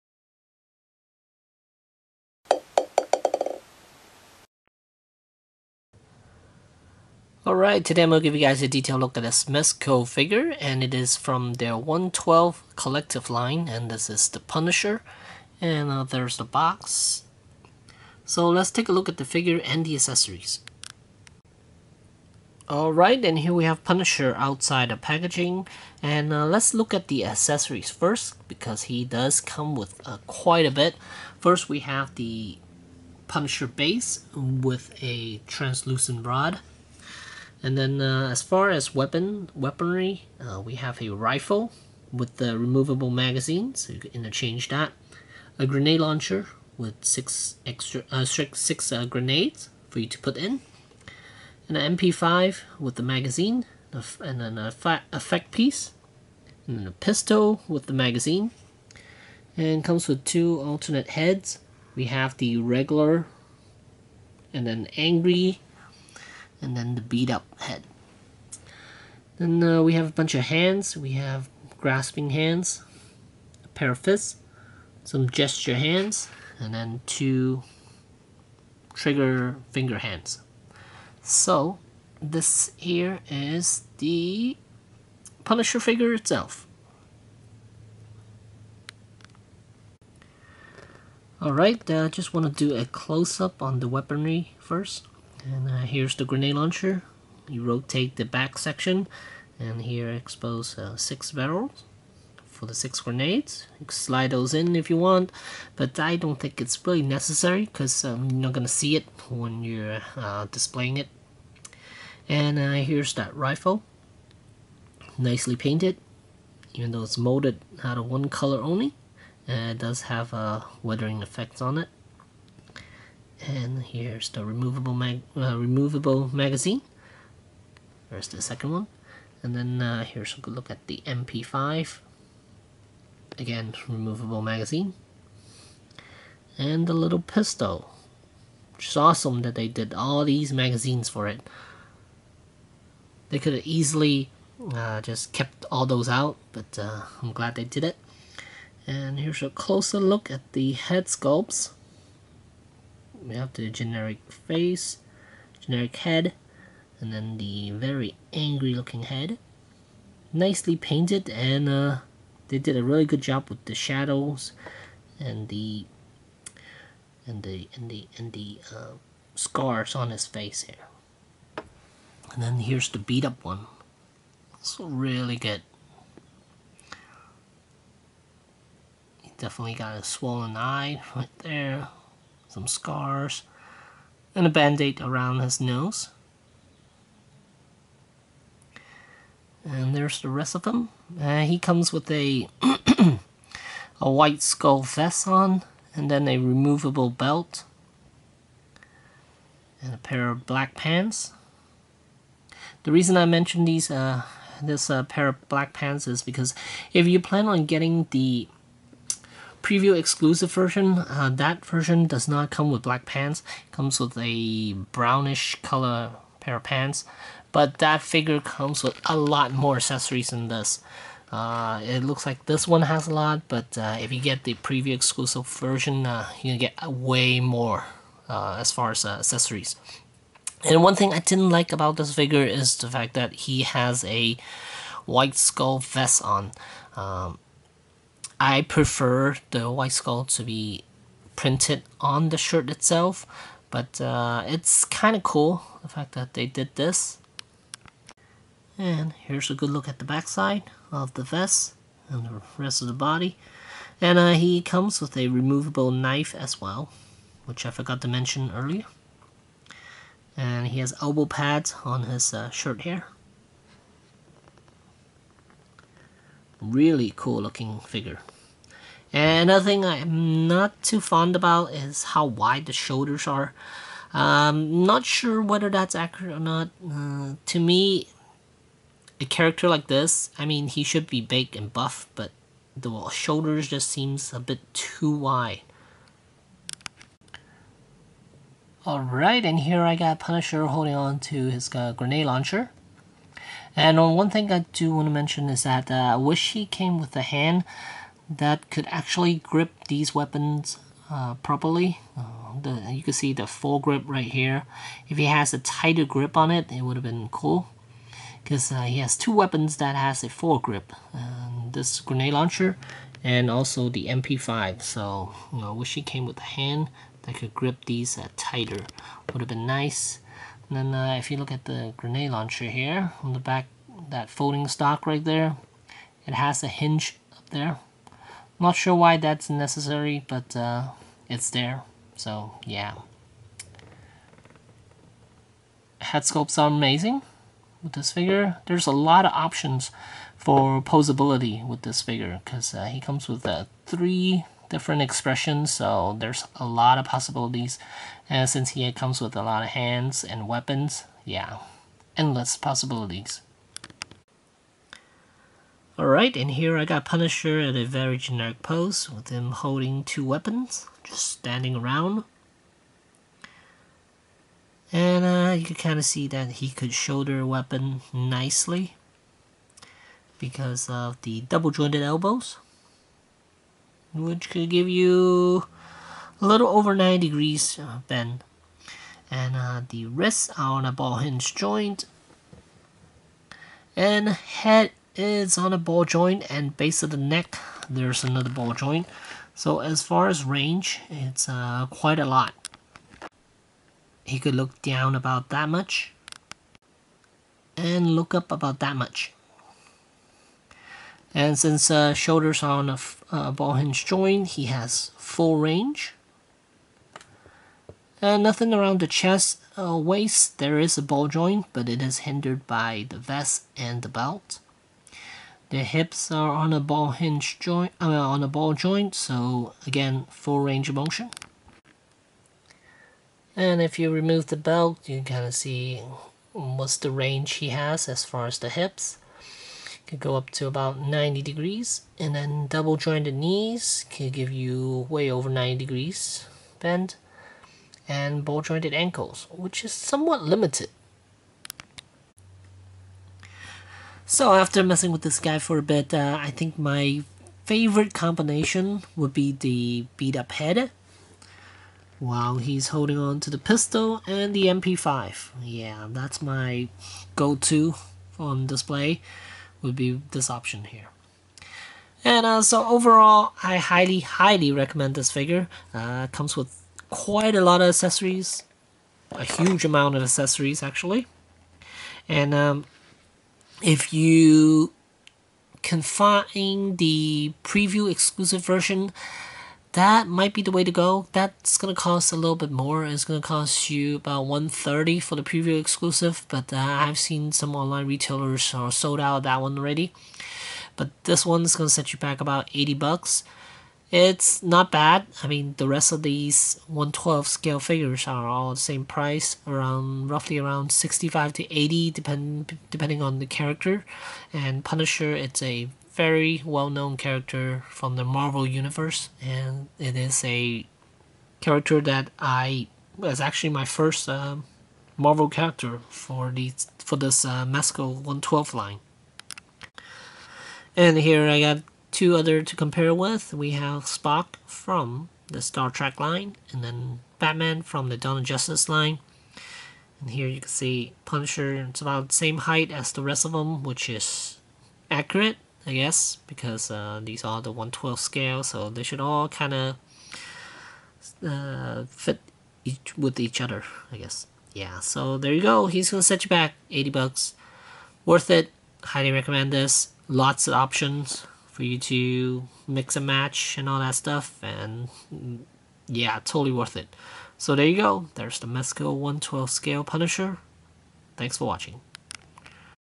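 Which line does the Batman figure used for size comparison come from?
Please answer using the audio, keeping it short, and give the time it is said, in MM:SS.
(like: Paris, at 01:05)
Dawn of Justice, at 08:48.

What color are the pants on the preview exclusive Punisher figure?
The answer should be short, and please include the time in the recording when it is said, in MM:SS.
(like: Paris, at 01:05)
Brownish, at 03:34.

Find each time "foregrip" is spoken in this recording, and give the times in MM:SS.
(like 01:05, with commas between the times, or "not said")
05:03, 05:10.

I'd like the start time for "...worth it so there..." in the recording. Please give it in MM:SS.
09:16.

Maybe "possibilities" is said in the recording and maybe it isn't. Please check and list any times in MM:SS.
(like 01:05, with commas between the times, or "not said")
05:47, 05:52.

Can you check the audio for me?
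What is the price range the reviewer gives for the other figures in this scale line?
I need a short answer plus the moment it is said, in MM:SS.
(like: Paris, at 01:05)
65 to 80, at 08:20.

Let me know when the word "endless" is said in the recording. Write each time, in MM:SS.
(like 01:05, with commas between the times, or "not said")
05:52.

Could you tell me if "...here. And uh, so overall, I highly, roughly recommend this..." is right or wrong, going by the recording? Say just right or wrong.
wrong.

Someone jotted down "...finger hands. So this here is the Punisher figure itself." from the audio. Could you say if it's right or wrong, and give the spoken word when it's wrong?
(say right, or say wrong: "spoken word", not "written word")
right.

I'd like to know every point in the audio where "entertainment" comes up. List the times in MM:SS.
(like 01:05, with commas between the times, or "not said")
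not said.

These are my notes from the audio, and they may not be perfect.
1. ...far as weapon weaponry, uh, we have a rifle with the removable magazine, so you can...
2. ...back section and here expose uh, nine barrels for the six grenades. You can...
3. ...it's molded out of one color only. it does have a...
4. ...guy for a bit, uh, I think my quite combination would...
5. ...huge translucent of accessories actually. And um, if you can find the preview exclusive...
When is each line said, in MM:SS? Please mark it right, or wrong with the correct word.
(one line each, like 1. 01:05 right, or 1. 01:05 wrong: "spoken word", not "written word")
1. 00:38 right
2. 01:38 wrong: "six", not "nine"
3. 01:57 right
4. 07:25 wrong: "favorite", not "quite"
5. 07:49 wrong: "amount", not "translucent".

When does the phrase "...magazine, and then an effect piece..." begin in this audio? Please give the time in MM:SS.
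00:53.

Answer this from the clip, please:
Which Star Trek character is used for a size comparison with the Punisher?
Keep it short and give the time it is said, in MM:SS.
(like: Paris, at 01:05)
Spock, at 08:44.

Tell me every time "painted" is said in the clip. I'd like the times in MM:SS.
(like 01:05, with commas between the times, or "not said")
01:55, 02:40.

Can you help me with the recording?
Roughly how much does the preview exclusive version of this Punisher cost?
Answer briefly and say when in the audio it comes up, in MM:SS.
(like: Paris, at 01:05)
130, at 08:04.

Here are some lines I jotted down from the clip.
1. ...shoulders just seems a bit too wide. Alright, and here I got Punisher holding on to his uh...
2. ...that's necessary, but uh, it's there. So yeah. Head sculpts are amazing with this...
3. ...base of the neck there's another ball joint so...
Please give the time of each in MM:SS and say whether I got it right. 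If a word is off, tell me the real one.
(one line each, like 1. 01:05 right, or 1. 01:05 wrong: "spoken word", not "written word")
1. 04:43 right
2. 05:29 right
3. 06:26 right.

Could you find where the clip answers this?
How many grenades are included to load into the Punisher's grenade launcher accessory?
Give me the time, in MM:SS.
00:48.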